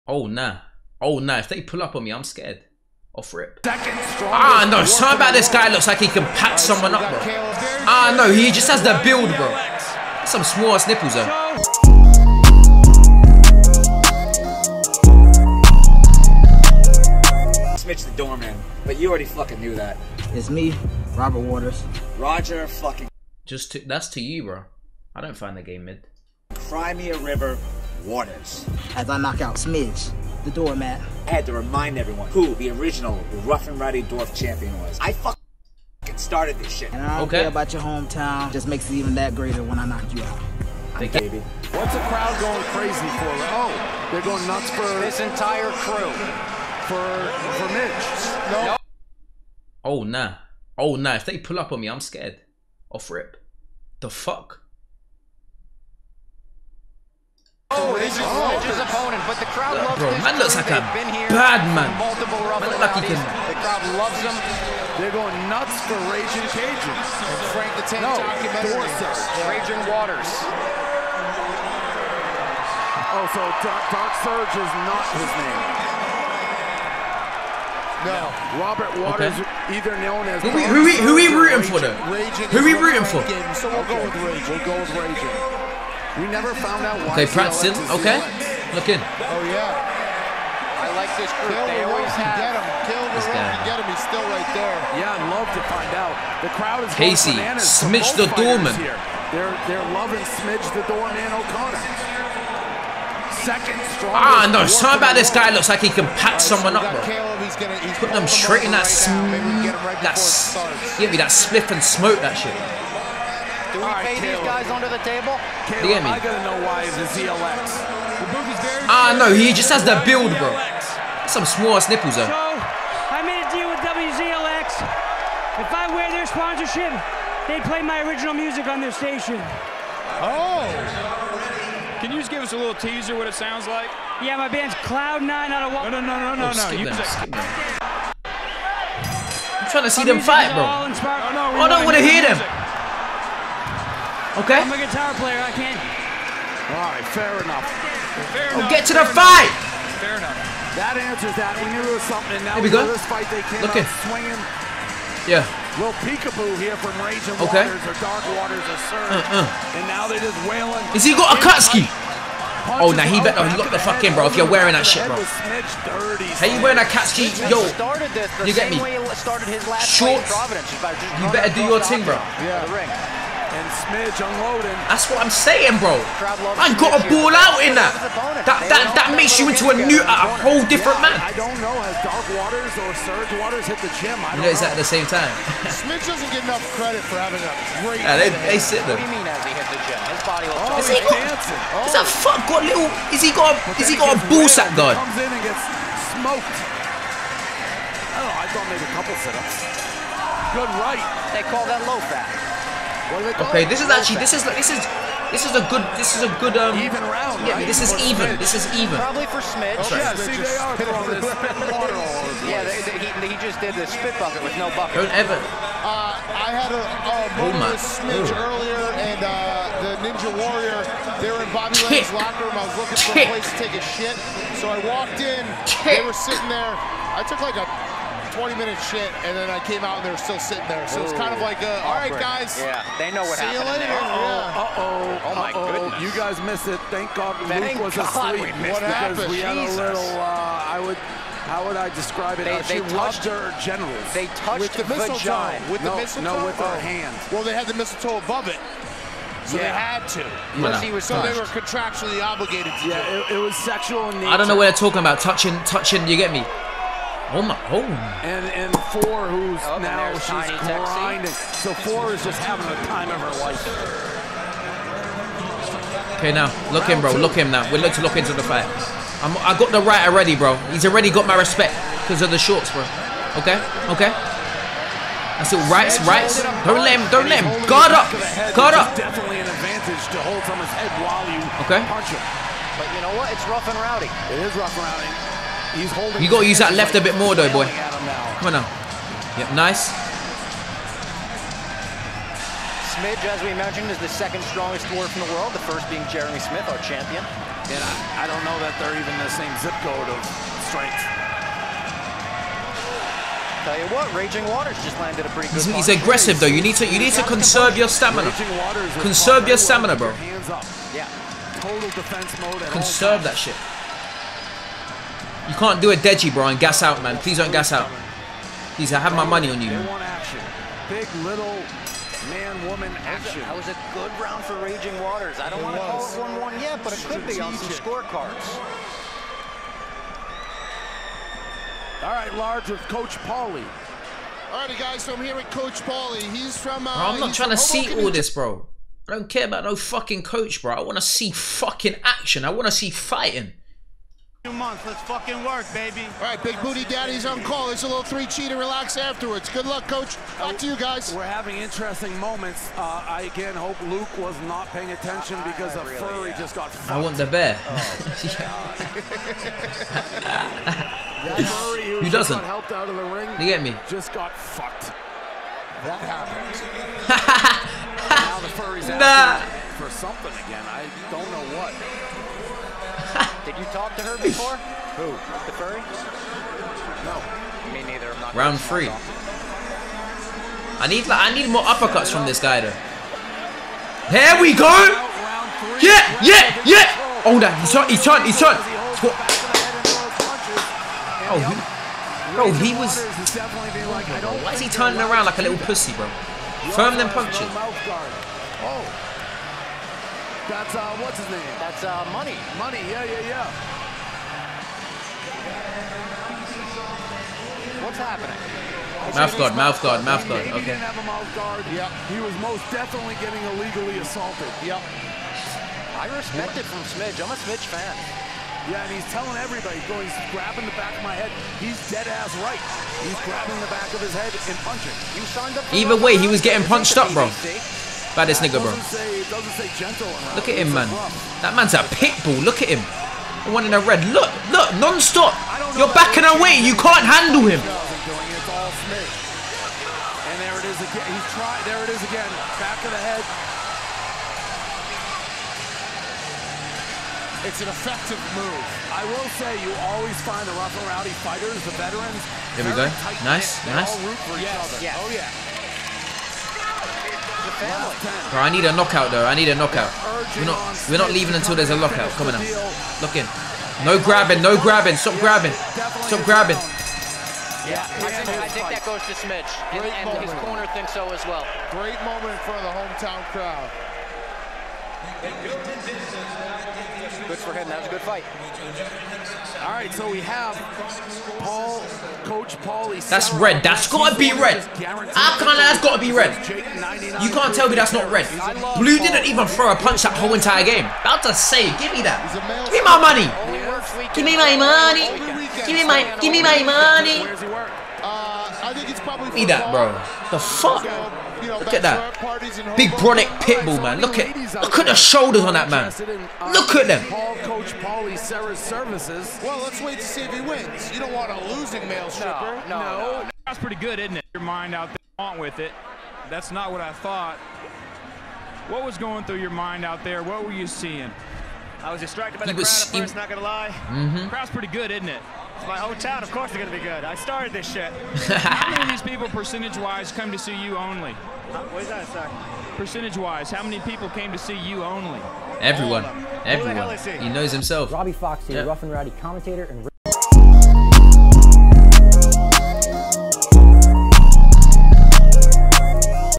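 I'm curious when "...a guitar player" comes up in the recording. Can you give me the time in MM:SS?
02:24.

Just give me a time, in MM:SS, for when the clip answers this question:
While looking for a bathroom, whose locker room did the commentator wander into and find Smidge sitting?
03:41.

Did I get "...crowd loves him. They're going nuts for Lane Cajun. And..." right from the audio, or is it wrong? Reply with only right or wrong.
wrong.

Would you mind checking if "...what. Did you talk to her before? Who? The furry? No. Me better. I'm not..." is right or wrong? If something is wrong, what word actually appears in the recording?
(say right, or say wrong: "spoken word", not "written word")
wrong: "neither", not "better".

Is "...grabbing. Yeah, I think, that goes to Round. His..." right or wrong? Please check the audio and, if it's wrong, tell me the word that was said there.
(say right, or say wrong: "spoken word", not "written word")
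wrong: "Smidge", not "Round".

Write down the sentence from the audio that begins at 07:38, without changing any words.
Bro, I need a knockout though.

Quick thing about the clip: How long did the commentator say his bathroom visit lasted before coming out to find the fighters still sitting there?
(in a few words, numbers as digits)
20 minutes.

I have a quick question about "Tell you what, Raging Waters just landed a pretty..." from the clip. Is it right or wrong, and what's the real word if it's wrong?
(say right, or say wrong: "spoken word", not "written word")
right.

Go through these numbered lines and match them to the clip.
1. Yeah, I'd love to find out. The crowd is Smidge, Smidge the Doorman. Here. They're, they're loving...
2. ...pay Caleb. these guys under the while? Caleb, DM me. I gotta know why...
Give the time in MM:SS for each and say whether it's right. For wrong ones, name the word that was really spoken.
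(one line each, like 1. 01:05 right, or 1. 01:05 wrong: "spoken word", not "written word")
1. 01:34 wrong: "Casey", not "Smidge"
2. 01:54 wrong: "table", not "while".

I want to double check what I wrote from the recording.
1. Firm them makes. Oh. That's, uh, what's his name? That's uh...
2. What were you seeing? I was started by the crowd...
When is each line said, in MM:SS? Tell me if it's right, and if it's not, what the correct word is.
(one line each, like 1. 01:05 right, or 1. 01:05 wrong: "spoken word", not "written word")
1. 06:36 wrong: "punches", not "makes"
2. 08:40 wrong: "distracted", not "started".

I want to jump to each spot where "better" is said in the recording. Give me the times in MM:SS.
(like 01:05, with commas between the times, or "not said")
02:43, 02:51.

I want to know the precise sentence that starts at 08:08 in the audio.
Blue didn't even throw a punch that whole entire game.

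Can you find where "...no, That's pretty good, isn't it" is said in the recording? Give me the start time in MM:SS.
08:32.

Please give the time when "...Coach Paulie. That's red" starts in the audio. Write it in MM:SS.
08:02.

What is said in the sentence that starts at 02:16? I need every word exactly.
You I'm trying to see them fight, bro.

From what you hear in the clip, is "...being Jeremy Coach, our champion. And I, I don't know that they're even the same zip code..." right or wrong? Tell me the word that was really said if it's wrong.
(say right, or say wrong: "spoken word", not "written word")
wrong: "Smith", not "Coach".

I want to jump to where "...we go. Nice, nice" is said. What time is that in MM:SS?
07:32.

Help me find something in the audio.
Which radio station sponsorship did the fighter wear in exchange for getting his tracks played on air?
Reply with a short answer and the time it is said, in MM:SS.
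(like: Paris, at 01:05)
WZLX, at 02:03.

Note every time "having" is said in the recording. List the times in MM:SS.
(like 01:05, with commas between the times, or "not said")
03:07, 04:22, 05:51.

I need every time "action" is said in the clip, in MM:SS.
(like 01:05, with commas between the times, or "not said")
05:23, 05:42.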